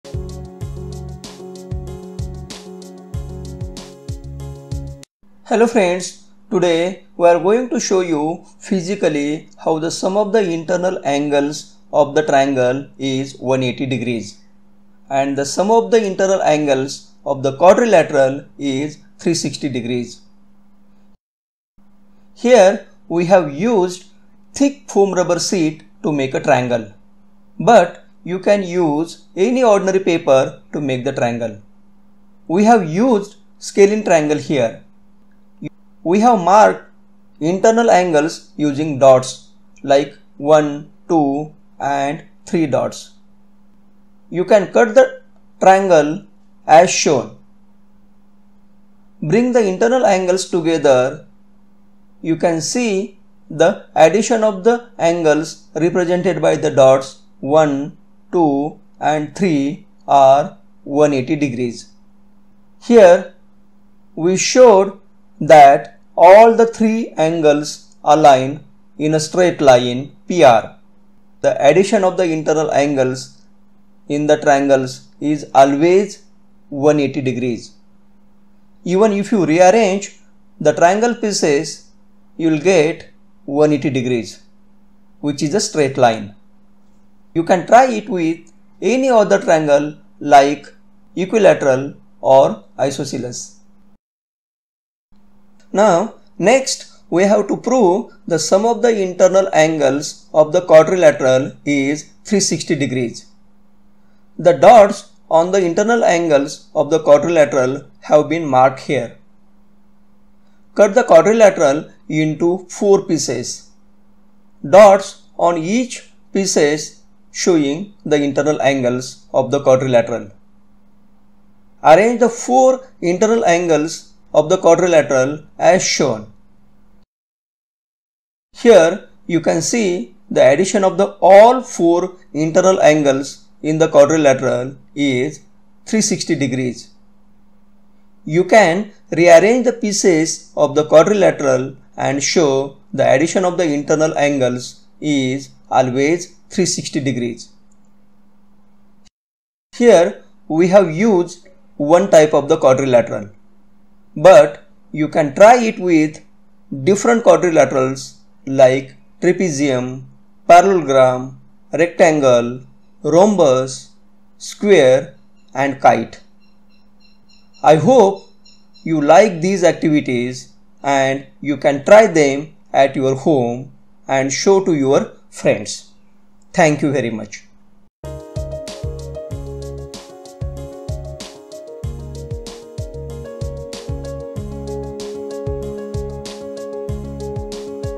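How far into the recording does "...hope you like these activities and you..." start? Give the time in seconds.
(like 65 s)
167 s.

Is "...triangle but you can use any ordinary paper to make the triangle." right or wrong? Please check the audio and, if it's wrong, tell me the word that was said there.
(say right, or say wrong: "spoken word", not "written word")
right.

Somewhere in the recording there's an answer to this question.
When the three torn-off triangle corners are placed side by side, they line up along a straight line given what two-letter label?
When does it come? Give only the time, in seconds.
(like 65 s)
70 s.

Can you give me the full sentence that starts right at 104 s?
The dots on the internal angles of the quadrilateral have been marked here.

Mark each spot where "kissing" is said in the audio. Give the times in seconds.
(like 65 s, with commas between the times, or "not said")
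not said.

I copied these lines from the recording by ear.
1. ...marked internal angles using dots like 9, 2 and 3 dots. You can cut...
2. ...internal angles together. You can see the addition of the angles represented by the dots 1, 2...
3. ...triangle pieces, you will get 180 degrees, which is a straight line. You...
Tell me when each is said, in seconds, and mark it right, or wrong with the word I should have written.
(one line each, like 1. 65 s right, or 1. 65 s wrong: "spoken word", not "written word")
1. 36 s wrong: "1", not "9"
2. 49 s right
3. 80 s right.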